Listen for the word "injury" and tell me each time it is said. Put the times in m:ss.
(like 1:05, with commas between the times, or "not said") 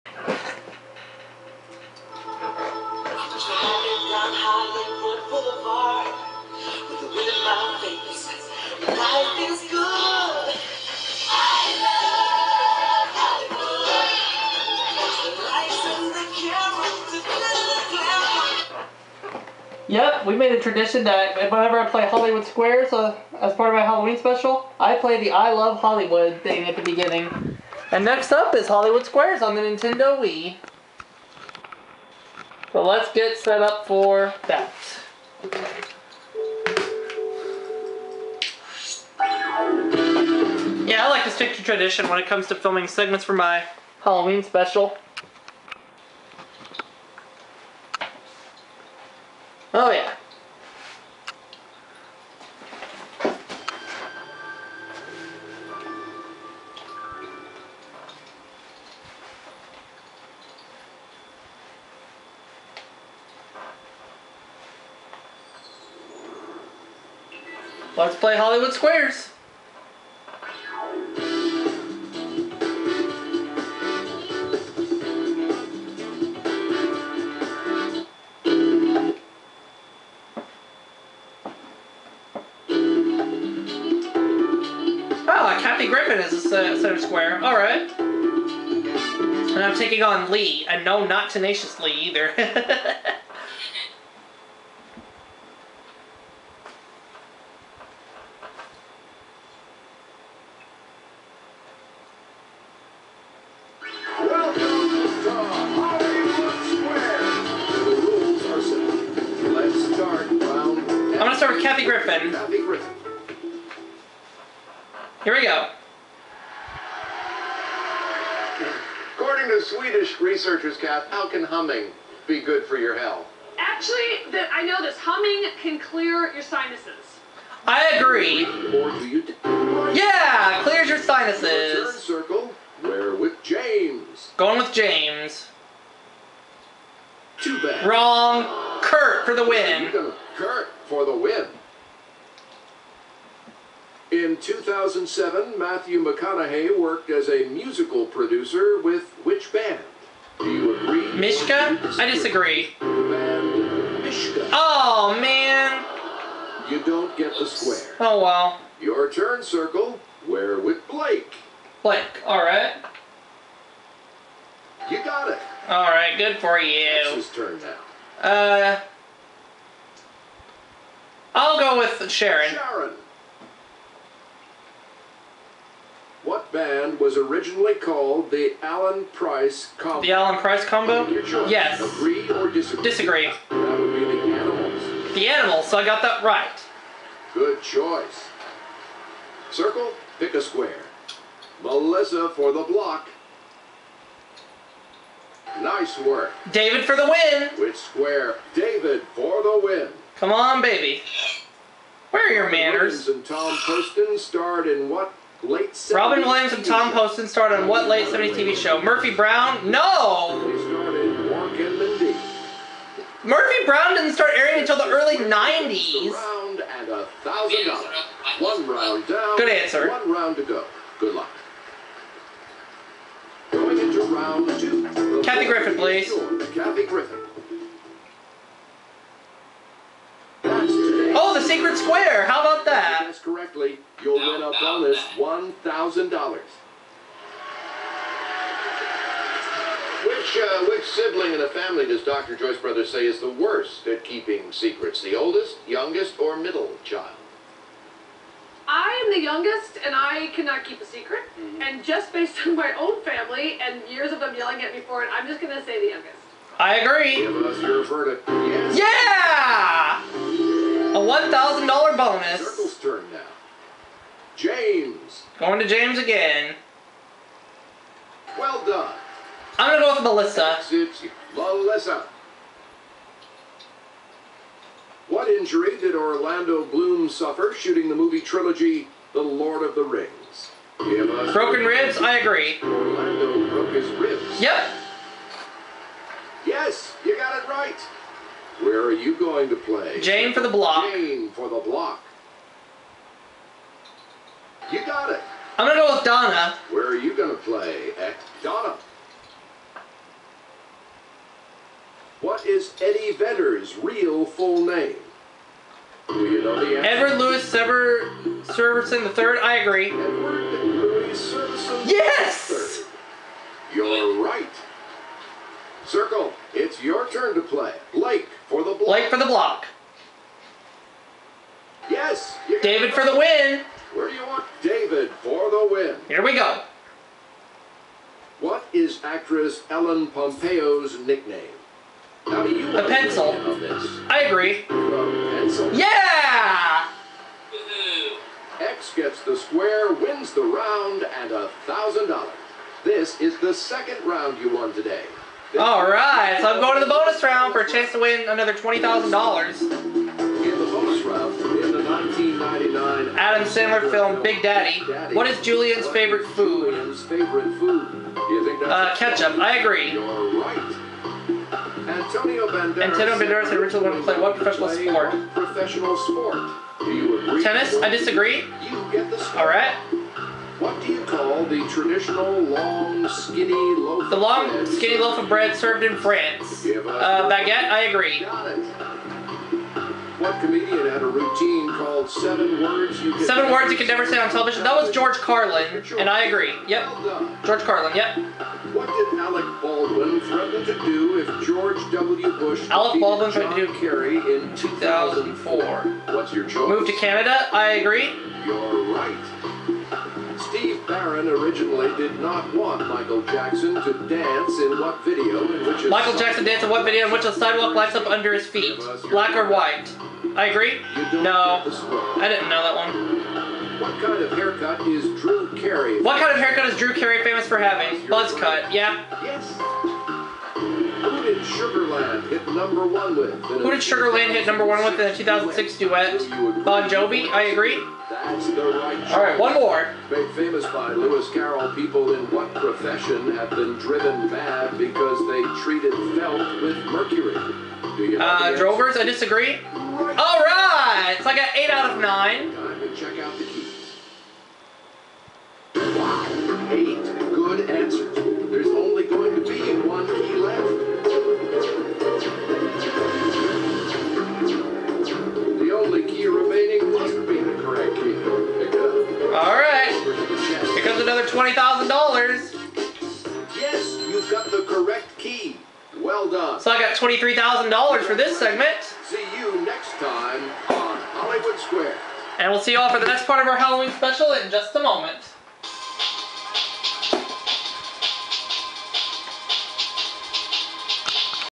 4:35.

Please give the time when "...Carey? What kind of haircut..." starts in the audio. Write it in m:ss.
6:55.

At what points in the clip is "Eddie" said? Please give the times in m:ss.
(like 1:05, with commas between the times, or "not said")
5:02.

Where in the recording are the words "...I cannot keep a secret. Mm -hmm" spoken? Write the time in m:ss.
4:09.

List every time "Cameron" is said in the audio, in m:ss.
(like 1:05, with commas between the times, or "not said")
not said.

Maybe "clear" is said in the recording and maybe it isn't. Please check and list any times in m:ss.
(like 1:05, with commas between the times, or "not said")
2:05, 2:10.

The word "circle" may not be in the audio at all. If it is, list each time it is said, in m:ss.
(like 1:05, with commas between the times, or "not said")
2:11, 2:39, 3:09, 4:22, 5:15.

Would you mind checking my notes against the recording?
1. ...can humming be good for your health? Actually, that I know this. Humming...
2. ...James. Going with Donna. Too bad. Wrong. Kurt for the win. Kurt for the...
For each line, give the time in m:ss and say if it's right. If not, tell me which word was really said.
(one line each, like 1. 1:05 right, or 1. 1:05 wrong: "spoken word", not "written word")
1. 2:01 right
2. 2:13 wrong: "James", not "Donna".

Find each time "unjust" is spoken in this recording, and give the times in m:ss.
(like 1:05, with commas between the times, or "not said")
not said.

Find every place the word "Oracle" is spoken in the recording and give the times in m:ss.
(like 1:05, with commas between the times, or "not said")
not said.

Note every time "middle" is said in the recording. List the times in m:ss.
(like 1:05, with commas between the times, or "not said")
4:06.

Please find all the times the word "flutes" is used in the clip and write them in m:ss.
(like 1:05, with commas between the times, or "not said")
not said.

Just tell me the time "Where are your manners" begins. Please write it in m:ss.
3:22.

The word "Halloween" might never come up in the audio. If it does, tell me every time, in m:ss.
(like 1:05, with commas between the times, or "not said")
0:23, 0:43, 7:53.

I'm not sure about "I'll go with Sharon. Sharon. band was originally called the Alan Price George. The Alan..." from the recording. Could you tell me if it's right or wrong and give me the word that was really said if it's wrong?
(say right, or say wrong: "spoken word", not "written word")
wrong: "Combo", not "George".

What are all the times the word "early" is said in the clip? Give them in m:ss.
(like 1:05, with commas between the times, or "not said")
3:34.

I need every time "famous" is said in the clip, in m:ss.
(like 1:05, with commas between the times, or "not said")
6:57, 7:10.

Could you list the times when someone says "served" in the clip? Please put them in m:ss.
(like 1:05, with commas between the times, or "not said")
6:15.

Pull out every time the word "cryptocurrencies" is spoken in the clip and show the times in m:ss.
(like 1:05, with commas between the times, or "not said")
not said.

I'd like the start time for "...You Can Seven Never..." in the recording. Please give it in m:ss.
6:23.